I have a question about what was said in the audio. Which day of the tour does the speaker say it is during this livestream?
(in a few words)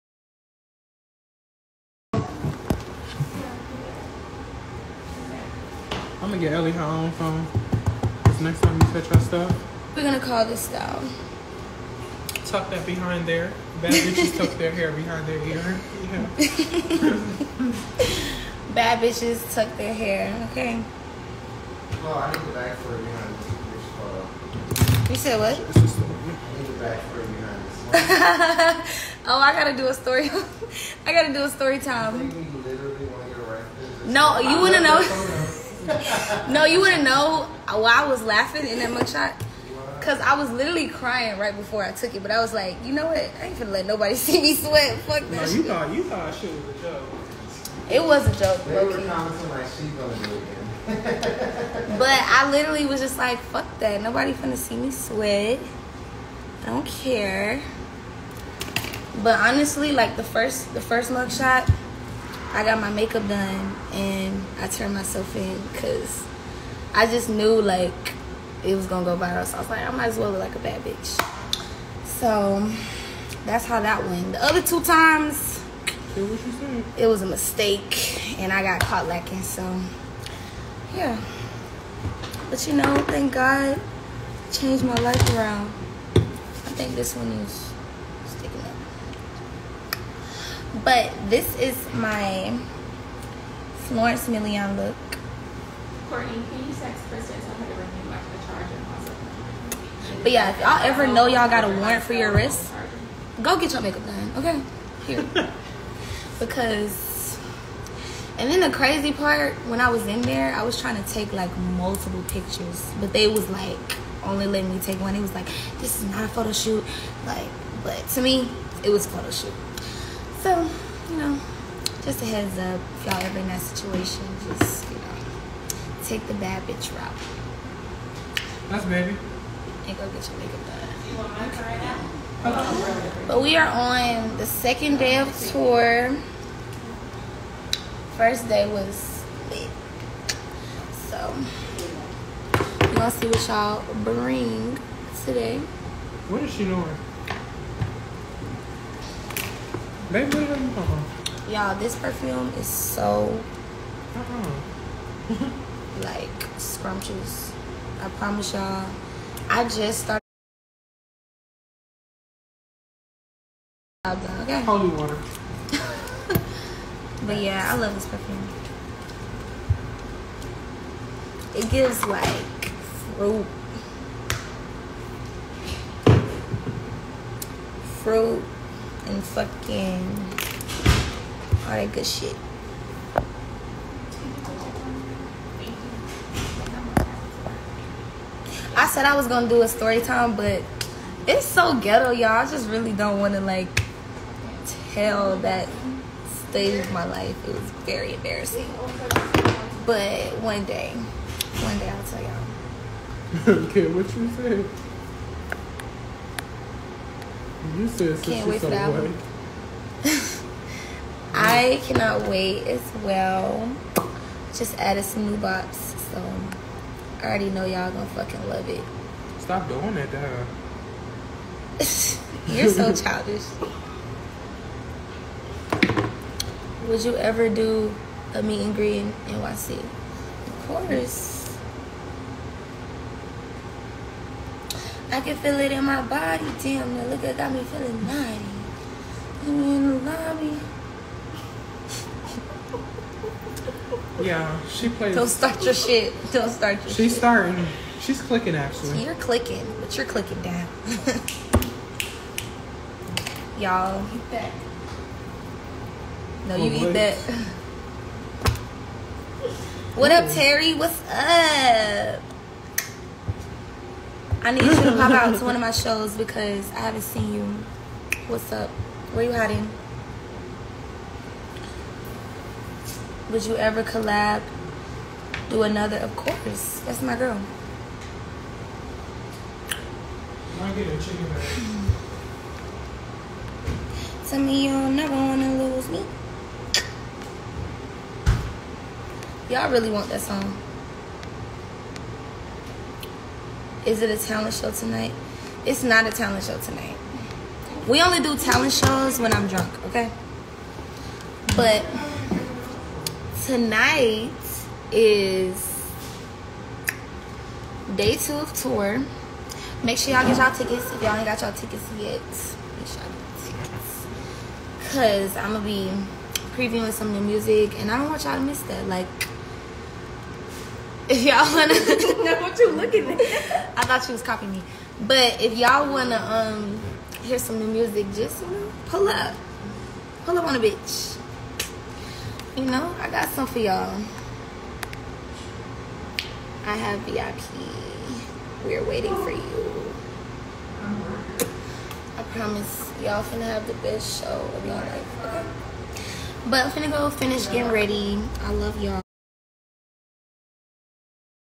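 Second day.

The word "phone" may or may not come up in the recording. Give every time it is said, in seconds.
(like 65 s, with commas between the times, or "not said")
7 s.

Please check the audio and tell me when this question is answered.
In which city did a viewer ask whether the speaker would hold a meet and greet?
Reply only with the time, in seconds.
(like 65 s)
229 s.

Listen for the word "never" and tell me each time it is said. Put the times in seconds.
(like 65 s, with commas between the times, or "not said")
284 s.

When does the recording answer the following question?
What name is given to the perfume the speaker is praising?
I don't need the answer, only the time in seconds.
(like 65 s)
164 s.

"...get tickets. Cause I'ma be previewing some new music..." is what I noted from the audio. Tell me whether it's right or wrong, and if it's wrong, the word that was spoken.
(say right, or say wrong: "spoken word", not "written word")
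right.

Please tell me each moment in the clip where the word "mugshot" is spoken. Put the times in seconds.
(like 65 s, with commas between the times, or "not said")
38 s, 61 s.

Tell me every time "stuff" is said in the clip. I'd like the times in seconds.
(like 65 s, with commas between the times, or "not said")
9 s.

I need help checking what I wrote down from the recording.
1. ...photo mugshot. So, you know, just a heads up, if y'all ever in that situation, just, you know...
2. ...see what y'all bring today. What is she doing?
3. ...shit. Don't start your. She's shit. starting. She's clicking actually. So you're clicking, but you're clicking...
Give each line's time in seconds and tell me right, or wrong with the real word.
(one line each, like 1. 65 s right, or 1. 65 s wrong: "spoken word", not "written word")
1. 119 s wrong: "shoot", not "mugshot"
2. 143 s right
3. 245 s right.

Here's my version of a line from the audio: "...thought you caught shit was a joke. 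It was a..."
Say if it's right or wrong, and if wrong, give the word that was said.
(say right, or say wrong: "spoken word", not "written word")
wrong: "thought", not "caught".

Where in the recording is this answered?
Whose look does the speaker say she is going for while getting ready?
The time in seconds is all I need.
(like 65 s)
93 s.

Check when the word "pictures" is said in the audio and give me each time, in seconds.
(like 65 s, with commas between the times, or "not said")
112 s.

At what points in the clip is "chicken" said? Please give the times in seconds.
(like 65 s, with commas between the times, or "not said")
280 s.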